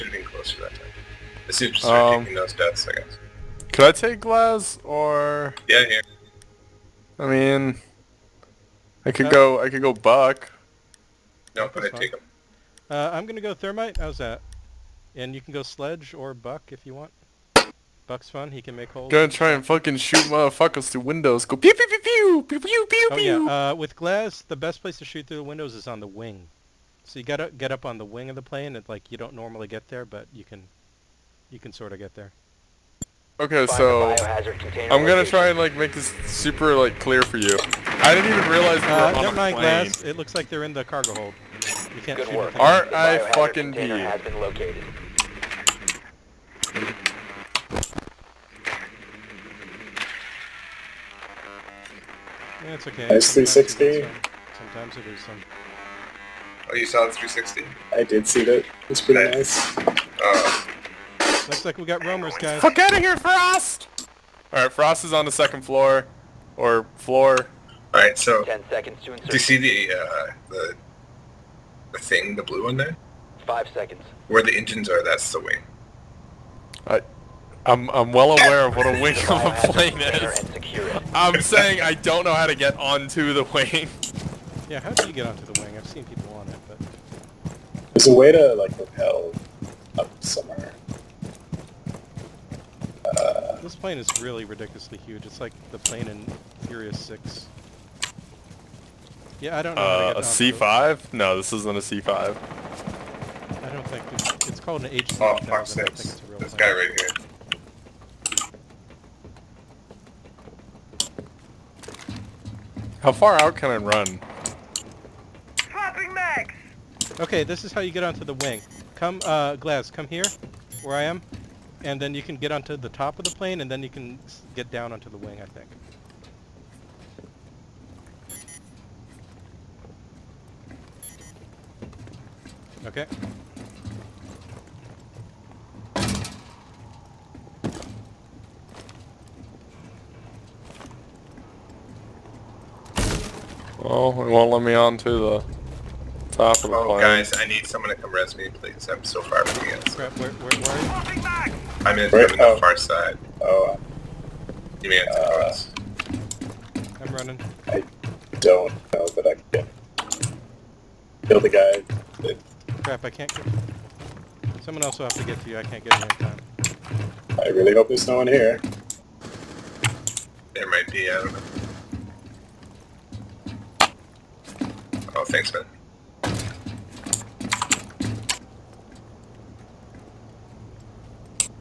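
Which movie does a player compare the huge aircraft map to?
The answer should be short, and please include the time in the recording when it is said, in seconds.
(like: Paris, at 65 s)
Furious 6, at 96 s.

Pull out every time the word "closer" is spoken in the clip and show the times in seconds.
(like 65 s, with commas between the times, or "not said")
0 s.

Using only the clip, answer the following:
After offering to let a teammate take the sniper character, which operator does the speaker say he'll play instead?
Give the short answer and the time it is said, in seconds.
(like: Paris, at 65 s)
Thermite, at 13 s.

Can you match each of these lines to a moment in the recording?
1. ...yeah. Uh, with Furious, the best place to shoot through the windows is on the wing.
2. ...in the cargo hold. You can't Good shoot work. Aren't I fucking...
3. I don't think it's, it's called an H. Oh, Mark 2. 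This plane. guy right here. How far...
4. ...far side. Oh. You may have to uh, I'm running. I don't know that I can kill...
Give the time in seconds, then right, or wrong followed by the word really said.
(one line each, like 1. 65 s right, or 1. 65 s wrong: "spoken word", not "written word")
1. 23 s wrong: "Glaz", not "Furious"
2. 40 s right
3. 103 s wrong: "6", not "2"
4. 152 s right.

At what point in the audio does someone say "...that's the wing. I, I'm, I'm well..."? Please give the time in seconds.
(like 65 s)
75 s.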